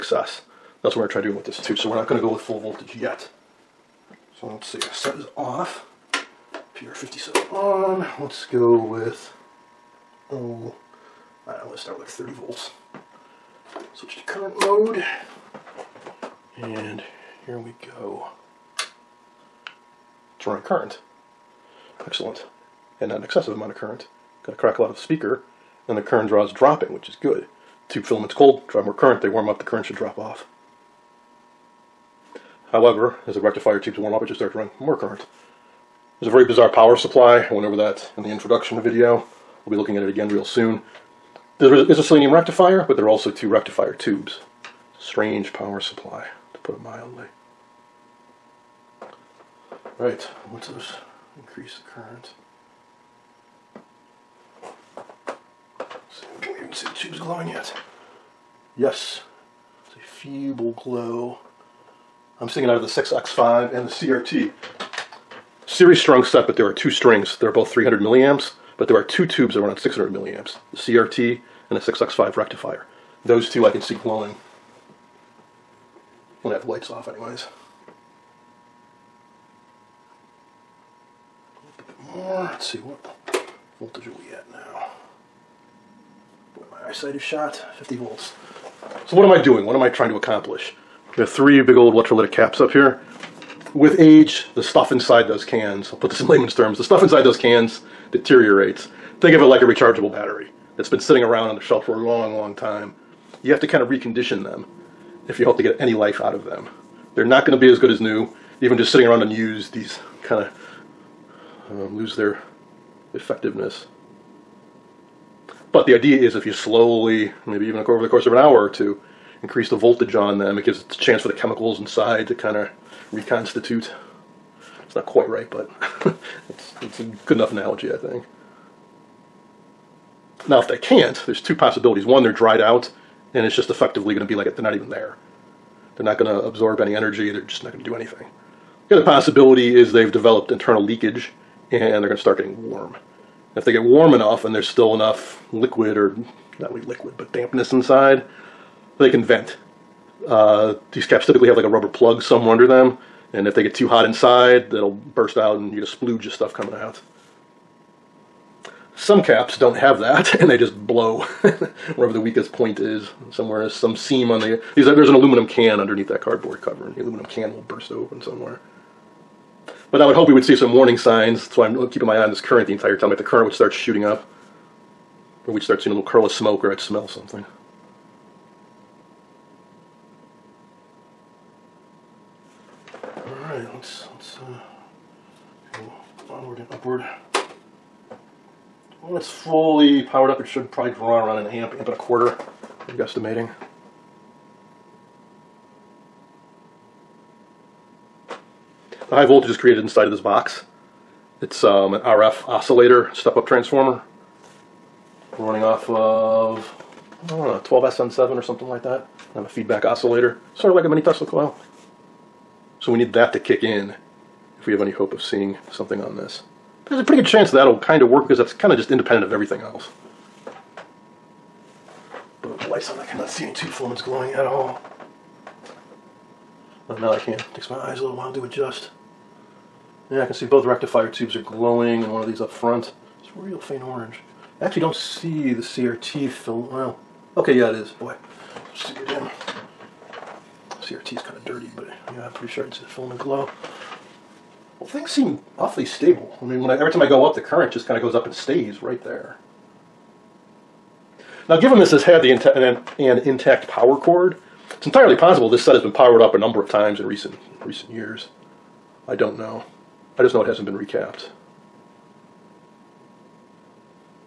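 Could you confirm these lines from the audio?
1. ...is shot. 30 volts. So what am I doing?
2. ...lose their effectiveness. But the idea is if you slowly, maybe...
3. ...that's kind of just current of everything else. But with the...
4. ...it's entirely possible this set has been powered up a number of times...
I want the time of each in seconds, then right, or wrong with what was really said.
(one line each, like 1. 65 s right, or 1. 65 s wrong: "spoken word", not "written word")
1. 87 s wrong: "50", not "30"
2. 111 s right
3. 218 s wrong: "independent", not "current"
4. 254 s right.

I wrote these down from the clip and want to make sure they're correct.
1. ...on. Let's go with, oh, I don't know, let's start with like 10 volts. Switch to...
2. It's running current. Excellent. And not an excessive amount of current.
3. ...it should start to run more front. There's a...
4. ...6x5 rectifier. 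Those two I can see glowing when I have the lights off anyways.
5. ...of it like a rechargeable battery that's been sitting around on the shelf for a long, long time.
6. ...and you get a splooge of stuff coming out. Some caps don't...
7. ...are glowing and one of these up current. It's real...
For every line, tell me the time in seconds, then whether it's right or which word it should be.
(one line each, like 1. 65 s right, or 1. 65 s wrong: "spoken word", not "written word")
1. 7 s wrong: "30", not "10"
2. 20 s right
3. 34 s wrong: "current", not "front"
4. 71 s right
5. 99 s right
6. 155 s right
7. 231 s wrong: "front", not "current".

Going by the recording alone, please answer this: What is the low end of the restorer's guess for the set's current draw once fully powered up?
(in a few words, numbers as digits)
around an amp.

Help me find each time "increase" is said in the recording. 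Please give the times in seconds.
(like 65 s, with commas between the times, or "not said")
51 s, 119 s.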